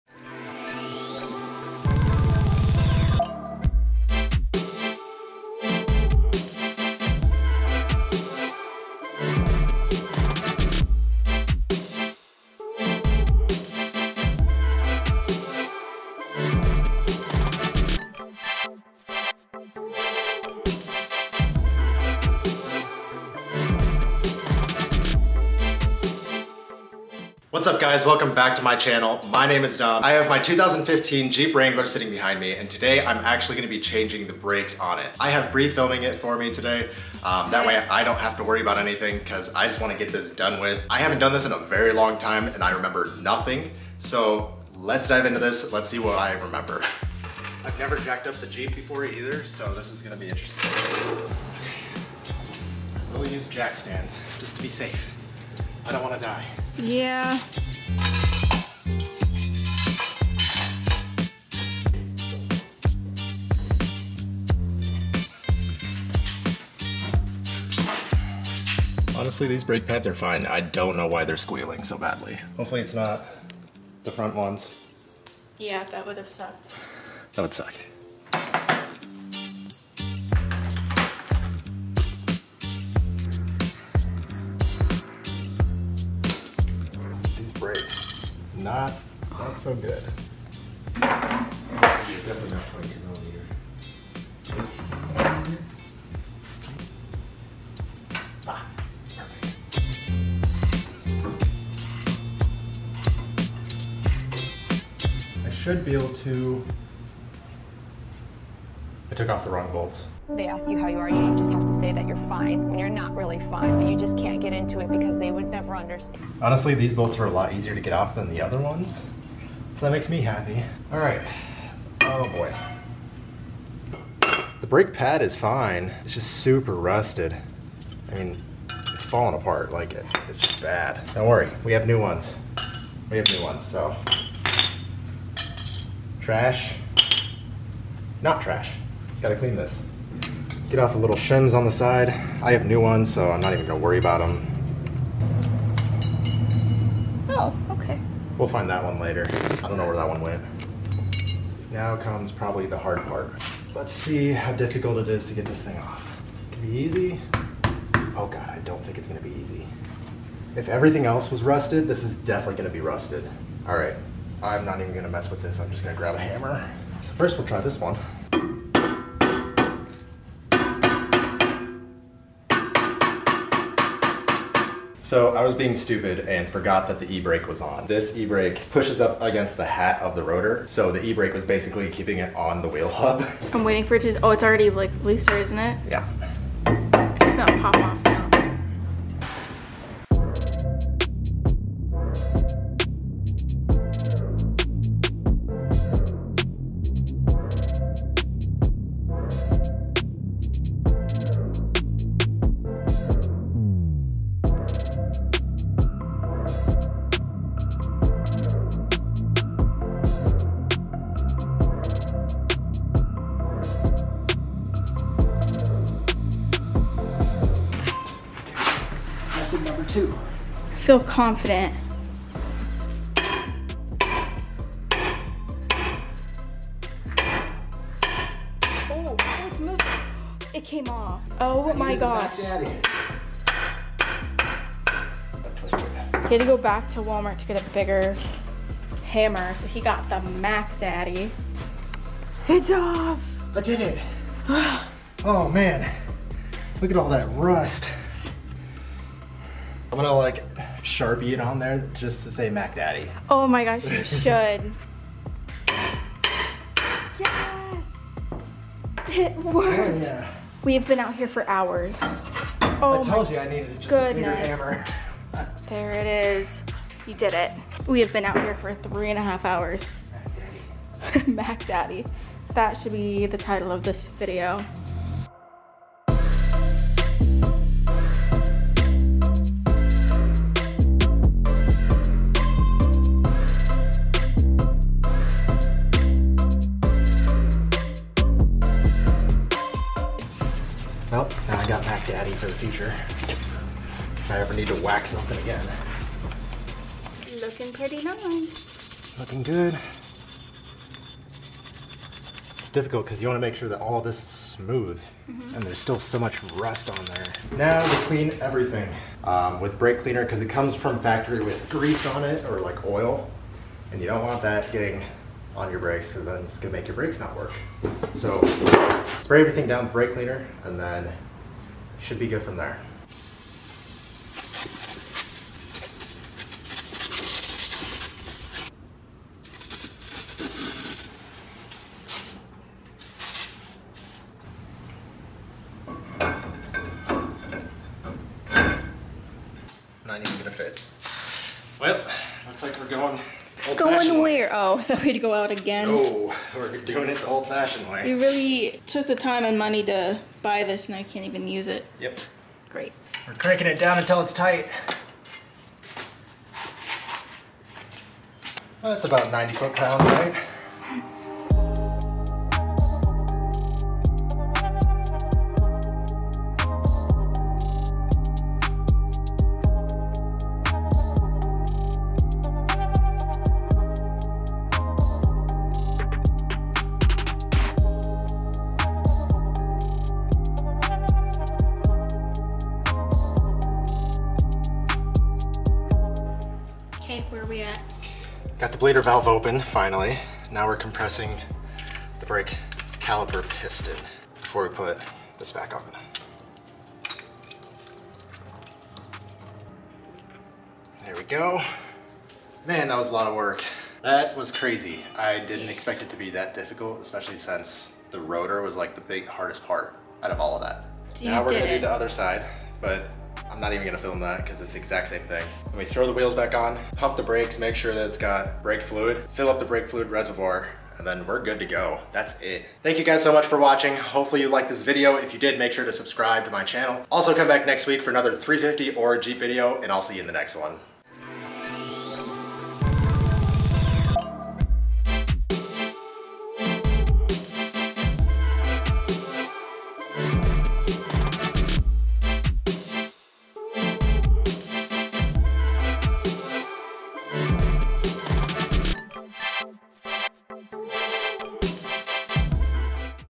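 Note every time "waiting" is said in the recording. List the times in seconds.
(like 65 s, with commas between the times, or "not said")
183 s.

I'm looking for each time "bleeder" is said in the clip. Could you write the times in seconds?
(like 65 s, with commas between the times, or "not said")
388 s.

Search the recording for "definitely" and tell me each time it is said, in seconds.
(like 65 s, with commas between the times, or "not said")
90 s, 162 s.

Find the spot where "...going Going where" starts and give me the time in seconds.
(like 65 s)
342 s.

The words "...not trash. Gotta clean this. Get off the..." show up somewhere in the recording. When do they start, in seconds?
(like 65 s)
138 s.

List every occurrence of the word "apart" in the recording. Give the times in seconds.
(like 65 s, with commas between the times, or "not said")
129 s.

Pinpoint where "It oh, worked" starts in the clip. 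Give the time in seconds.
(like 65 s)
259 s.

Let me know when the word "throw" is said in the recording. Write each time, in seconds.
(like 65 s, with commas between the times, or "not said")
415 s.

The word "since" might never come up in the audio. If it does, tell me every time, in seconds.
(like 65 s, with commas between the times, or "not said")
407 s.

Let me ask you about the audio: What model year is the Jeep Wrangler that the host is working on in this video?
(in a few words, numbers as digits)
2015.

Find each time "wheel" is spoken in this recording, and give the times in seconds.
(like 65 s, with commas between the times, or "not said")
182 s, 416 s.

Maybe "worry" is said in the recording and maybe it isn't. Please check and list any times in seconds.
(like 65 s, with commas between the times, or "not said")
38 s, 131 s, 143 s.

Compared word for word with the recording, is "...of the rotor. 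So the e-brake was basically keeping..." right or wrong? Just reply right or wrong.
right.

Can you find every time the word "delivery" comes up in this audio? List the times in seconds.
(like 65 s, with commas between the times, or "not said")
not said.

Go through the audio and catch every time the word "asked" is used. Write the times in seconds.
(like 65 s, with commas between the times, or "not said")
not said.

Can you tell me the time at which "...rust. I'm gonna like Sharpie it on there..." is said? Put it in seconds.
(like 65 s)
247 s.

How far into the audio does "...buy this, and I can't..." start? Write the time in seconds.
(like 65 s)
350 s.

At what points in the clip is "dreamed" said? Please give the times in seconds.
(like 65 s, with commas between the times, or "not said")
not said.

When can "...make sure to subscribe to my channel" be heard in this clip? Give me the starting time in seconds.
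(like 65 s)
425 s.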